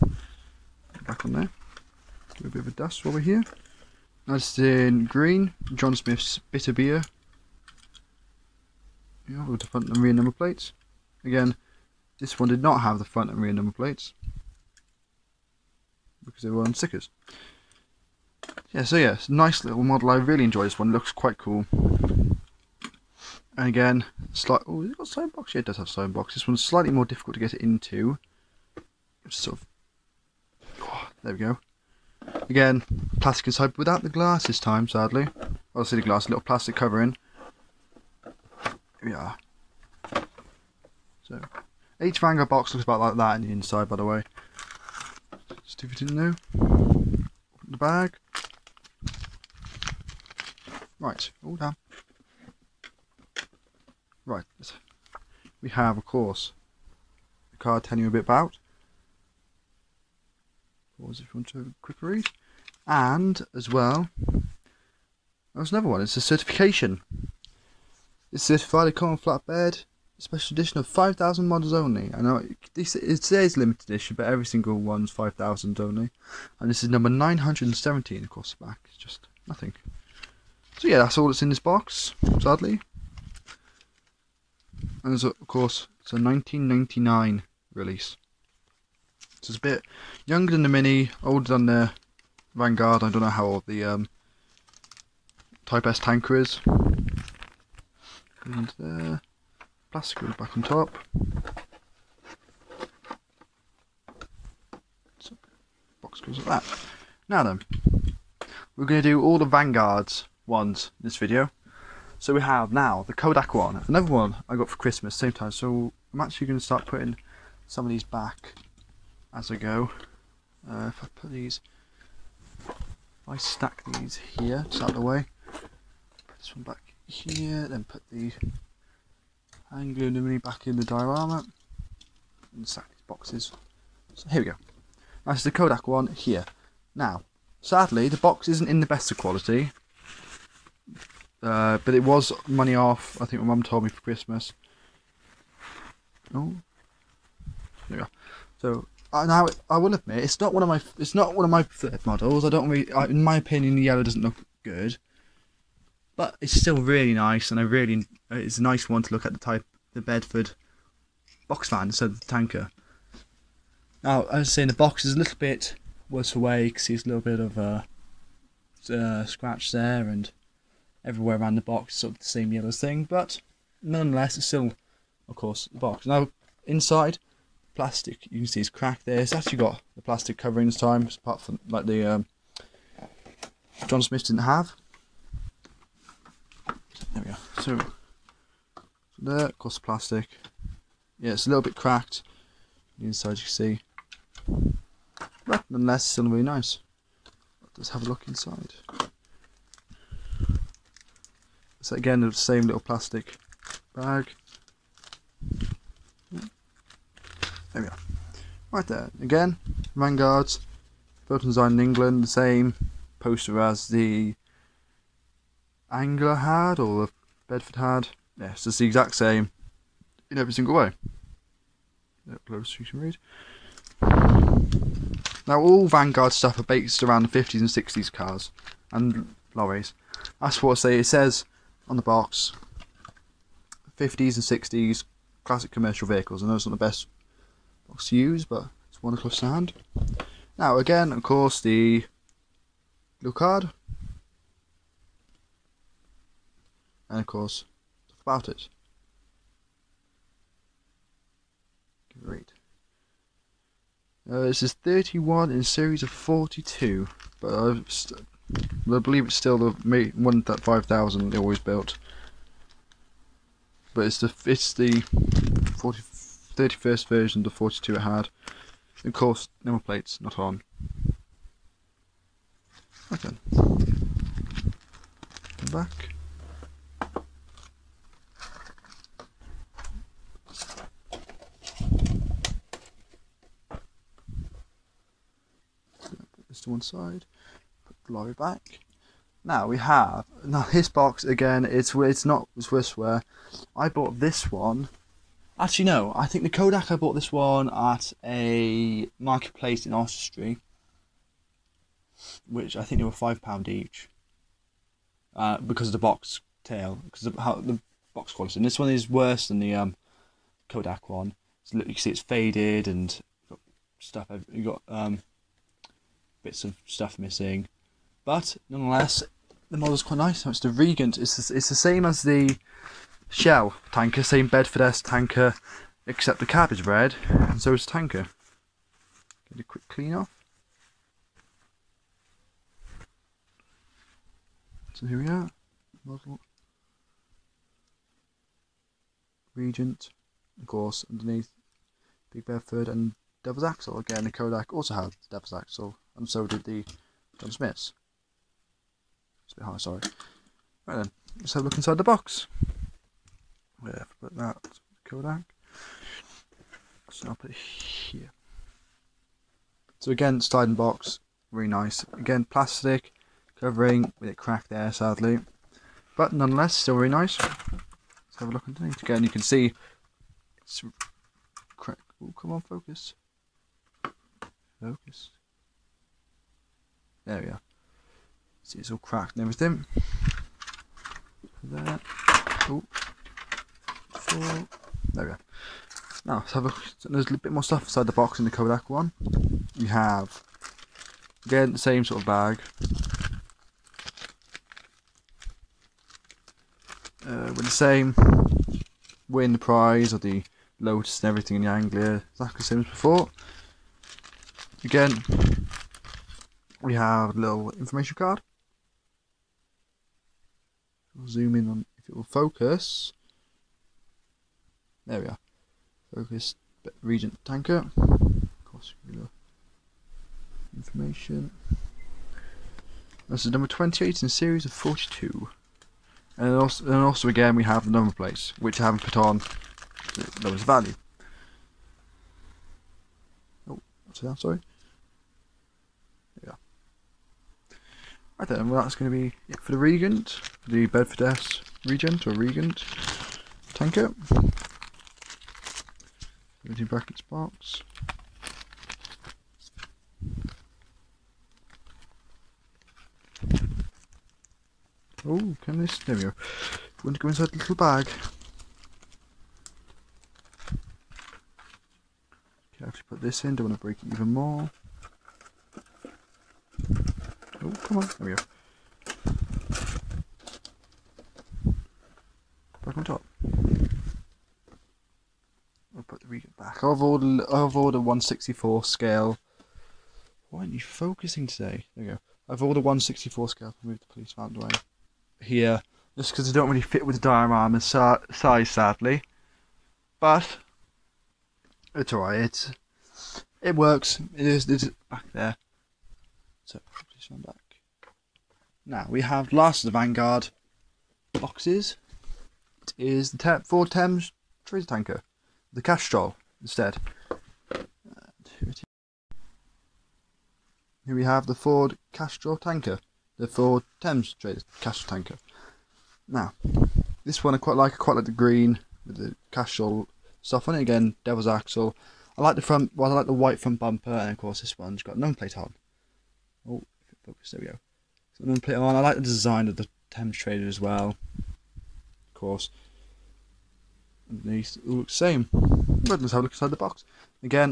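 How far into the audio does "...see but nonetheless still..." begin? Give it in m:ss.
3:13.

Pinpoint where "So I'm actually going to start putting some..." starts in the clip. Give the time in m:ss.
1:55.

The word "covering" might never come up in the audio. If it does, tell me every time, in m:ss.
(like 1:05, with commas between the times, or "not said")
0:36, 3:00, 6:03.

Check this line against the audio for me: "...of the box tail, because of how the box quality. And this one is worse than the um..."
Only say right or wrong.
right.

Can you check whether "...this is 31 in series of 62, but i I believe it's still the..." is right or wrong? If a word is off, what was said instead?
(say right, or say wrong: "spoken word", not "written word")
wrong: "42", not "62".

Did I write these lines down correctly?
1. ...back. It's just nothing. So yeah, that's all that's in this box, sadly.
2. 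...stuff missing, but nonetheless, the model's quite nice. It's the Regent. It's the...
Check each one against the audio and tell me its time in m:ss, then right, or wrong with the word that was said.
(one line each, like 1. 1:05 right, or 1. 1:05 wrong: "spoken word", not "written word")
1. 1:18 right
2. 5:16 right.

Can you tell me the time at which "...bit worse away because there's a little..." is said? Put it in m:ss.
2:45.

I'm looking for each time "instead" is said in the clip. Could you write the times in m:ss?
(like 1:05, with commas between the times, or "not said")
2:41, 8:26.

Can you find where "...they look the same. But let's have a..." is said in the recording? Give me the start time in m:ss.
8:54.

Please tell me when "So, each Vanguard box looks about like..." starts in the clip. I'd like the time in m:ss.
0:41.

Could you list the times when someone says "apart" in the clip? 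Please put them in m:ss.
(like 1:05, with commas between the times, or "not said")
3:01.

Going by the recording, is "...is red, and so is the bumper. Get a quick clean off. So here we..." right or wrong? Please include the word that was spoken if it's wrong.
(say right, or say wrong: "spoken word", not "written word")
wrong: "tanker", not "bumper".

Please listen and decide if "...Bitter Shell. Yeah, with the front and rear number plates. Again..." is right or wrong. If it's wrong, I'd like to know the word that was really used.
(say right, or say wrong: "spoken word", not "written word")
wrong: "Beer", not "Shell".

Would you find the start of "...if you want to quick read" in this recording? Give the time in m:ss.
1:01.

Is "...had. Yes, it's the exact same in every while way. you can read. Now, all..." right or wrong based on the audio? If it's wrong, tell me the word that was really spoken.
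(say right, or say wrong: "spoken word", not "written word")
wrong: "single", not "while".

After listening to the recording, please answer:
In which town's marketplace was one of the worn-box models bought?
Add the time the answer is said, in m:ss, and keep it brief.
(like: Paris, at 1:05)
Oswestry, at 4:59.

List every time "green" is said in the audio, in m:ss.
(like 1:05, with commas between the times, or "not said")
0:05, 8:38.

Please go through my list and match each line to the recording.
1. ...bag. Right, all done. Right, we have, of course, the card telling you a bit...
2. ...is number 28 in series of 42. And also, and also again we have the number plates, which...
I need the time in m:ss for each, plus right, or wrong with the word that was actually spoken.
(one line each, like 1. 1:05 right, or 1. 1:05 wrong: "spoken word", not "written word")
1. 0:47 right
2. 7:03 right.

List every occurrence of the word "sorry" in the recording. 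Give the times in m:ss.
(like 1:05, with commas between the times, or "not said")
5:49, 7:14.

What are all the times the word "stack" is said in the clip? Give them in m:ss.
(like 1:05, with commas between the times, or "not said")
2:03, 2:12.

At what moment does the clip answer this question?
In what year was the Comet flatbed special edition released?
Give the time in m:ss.
1:26.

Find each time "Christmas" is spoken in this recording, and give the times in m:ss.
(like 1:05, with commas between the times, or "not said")
1:54, 2:24.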